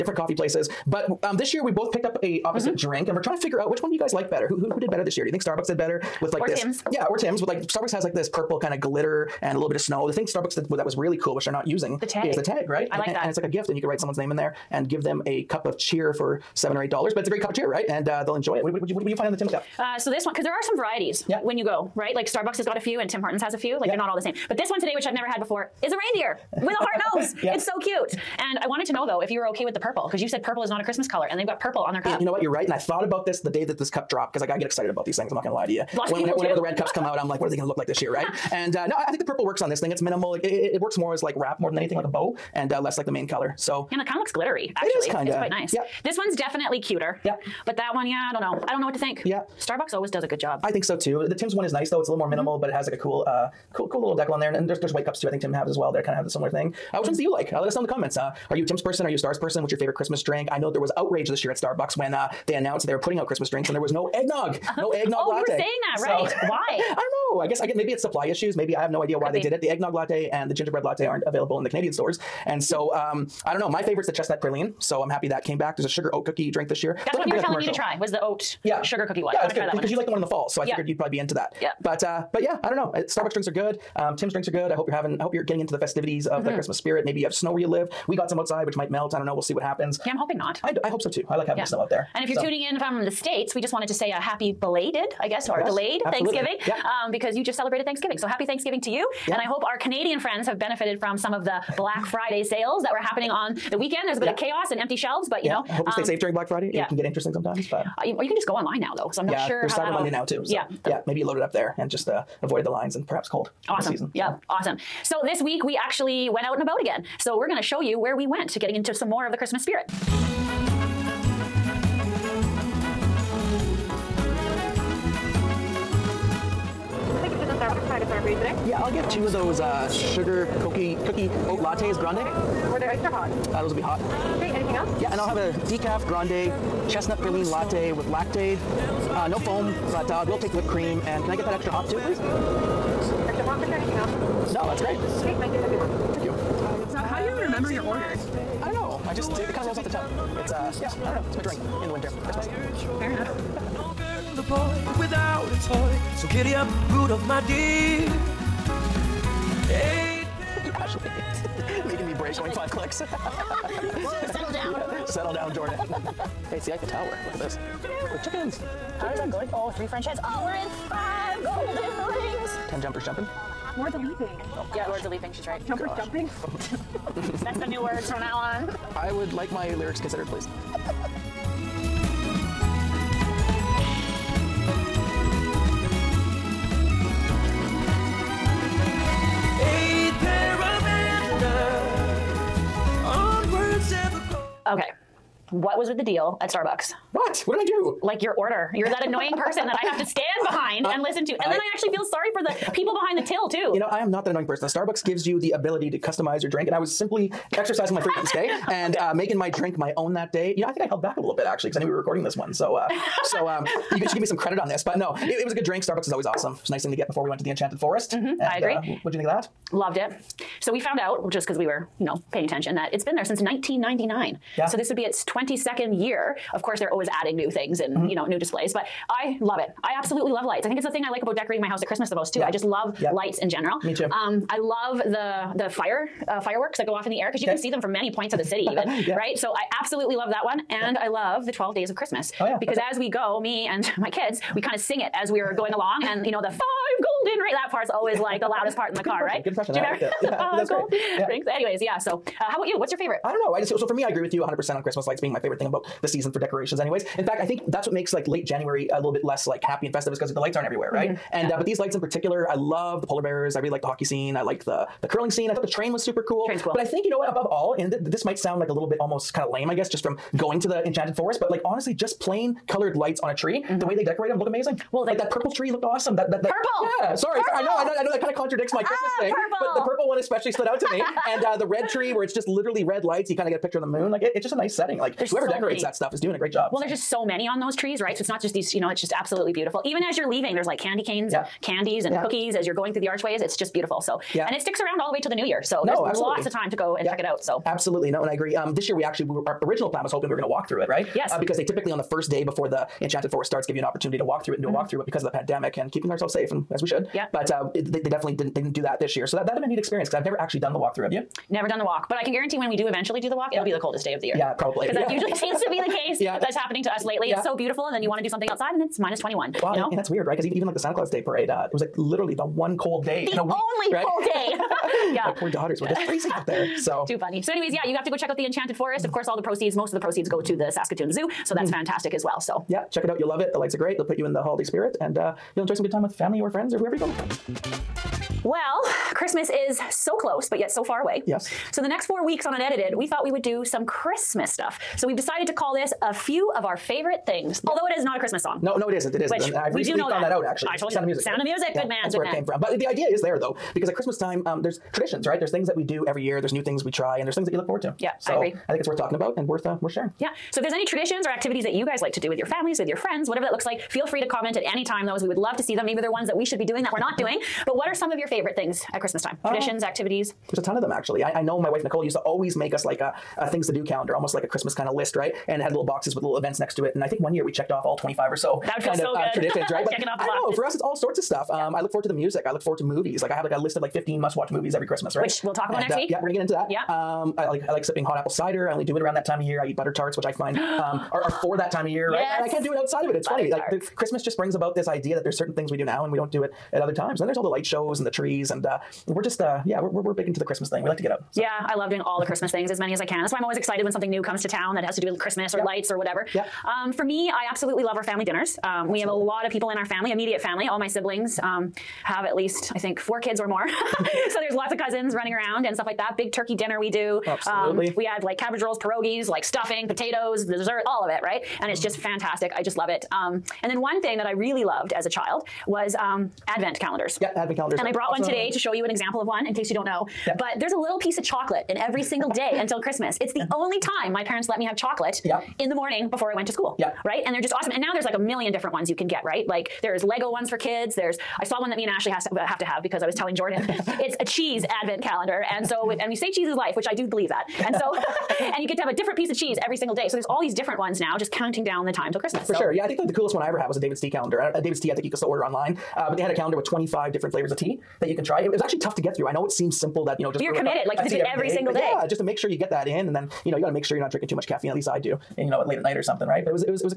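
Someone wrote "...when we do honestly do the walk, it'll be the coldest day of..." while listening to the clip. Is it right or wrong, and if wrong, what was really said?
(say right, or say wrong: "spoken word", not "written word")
wrong: "eventually", not "honestly".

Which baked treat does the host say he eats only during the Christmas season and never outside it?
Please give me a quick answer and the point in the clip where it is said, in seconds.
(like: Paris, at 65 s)
Butter tarts, at 389 s.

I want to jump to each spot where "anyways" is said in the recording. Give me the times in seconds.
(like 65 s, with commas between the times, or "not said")
251 s, 256 s, 327 s.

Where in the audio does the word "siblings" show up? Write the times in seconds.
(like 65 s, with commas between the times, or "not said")
410 s.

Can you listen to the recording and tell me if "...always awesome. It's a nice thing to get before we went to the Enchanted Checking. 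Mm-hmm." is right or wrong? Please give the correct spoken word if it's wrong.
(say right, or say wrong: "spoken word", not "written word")
wrong: "Forest", not "Checking".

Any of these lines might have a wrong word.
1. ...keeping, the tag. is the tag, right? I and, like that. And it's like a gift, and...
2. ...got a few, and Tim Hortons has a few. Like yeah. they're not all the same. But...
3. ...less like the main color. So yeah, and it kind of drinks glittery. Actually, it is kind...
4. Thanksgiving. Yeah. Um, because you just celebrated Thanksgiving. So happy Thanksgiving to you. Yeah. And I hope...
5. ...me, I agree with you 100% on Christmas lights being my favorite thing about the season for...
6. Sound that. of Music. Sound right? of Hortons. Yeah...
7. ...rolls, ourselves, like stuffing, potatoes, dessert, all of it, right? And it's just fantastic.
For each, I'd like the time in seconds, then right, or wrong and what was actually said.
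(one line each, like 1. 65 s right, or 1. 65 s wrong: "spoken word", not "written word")
1. 11 s wrong: "using", not "keeping"
2. 22 s right
3. 42 s wrong: "looks", not "drinks"
4. 96 s right
5. 253 s right
6. 350 s wrong: "Music", not "Hortons"
7. 418 s wrong: "pierogies", not "ourselves".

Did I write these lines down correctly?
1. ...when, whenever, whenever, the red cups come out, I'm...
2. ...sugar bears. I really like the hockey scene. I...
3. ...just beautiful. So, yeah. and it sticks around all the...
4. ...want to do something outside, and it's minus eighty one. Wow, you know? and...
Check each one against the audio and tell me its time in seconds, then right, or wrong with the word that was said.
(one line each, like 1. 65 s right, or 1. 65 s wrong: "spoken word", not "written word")
1. 36 s right
2. 263 s wrong: "polar", not "sugar"
3. 293 s right
4. 318 s wrong: "twenty", not "eighty".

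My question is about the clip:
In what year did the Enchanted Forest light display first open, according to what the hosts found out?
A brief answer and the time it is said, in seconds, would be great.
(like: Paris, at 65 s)
1999, at 223 s.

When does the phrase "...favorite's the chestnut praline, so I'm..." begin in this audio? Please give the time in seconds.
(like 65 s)
73 s.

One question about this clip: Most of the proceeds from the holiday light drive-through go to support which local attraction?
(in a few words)
Saskatoon Zoo.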